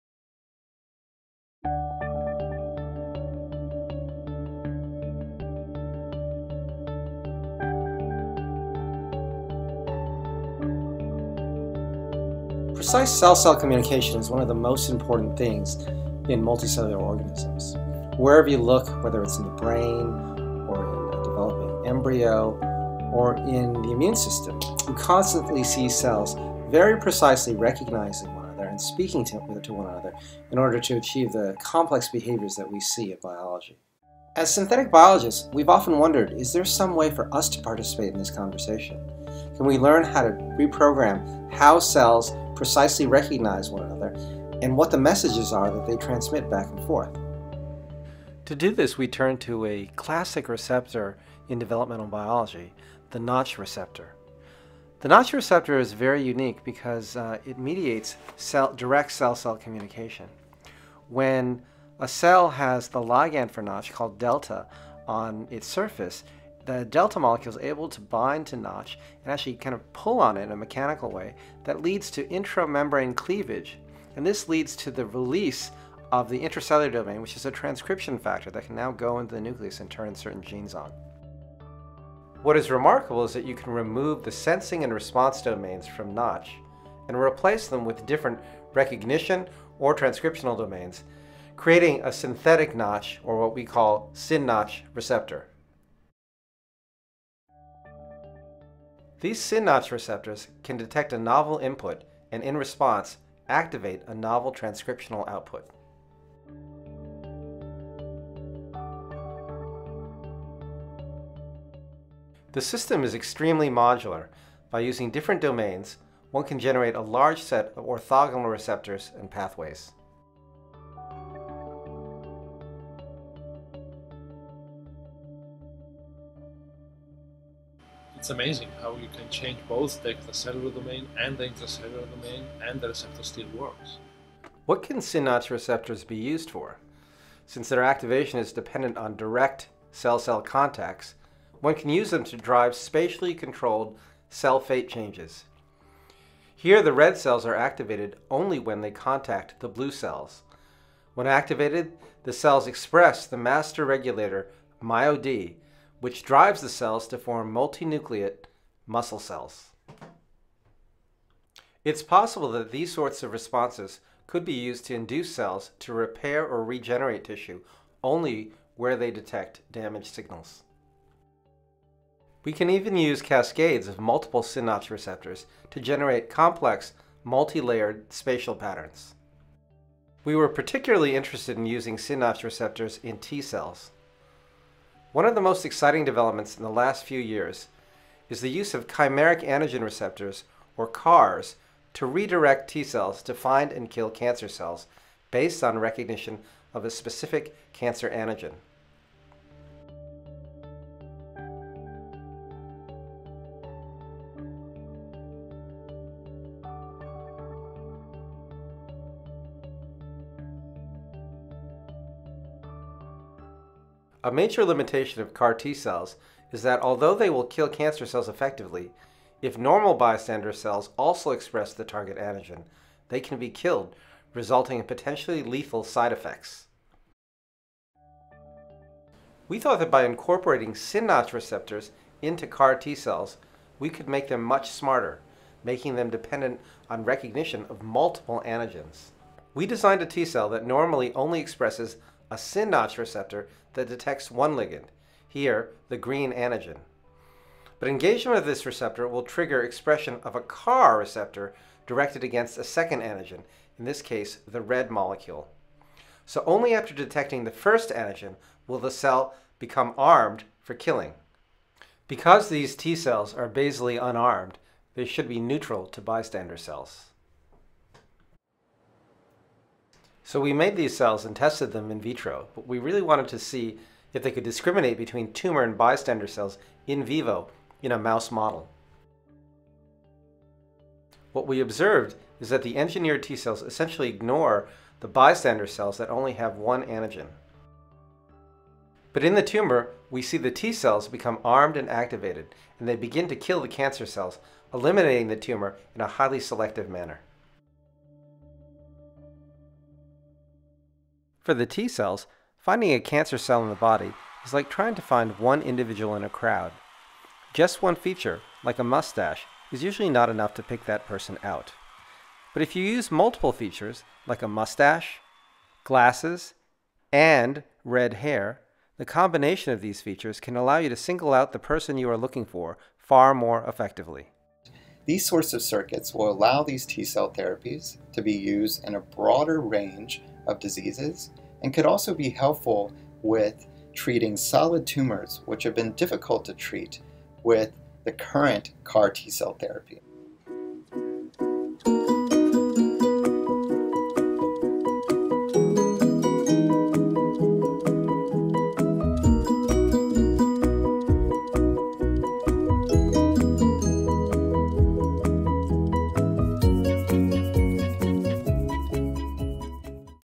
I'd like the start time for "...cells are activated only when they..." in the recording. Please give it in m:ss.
2:27.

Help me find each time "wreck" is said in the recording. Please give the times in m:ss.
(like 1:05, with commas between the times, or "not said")
not said.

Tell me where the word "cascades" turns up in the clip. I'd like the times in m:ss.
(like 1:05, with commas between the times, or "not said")
2:53.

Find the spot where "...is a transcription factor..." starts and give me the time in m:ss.
1:17.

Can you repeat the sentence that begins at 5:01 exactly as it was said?
For the T cells, finding a cancer cell in the body is like trying to find one individual in a crowd.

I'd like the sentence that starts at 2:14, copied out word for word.
What can synapse receptors be used for?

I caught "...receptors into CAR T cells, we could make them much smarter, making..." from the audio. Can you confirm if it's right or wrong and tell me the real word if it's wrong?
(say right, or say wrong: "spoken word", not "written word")
right.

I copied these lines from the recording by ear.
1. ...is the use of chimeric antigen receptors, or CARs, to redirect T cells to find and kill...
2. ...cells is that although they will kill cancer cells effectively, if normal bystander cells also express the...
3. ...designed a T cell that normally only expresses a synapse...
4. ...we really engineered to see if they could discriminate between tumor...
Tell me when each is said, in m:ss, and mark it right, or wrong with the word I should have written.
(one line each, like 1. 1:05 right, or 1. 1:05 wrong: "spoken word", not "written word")
1. 3:08 right
2. 3:35 right
3. 3:59 right
4. 4:32 wrong: "wanted", not "engineered".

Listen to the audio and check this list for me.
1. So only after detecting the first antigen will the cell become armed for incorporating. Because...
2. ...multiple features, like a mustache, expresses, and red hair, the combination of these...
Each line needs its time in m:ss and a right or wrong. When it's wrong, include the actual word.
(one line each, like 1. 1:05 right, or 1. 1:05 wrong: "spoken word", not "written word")
1. 4:16 wrong: "killing", not "incorporating"
2. 5:13 wrong: "glasses", not "expresses".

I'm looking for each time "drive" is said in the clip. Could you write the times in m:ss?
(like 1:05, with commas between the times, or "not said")
2:22, 2:36.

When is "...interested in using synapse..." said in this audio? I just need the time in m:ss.
3:01.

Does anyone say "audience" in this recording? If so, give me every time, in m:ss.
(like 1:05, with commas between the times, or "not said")
not said.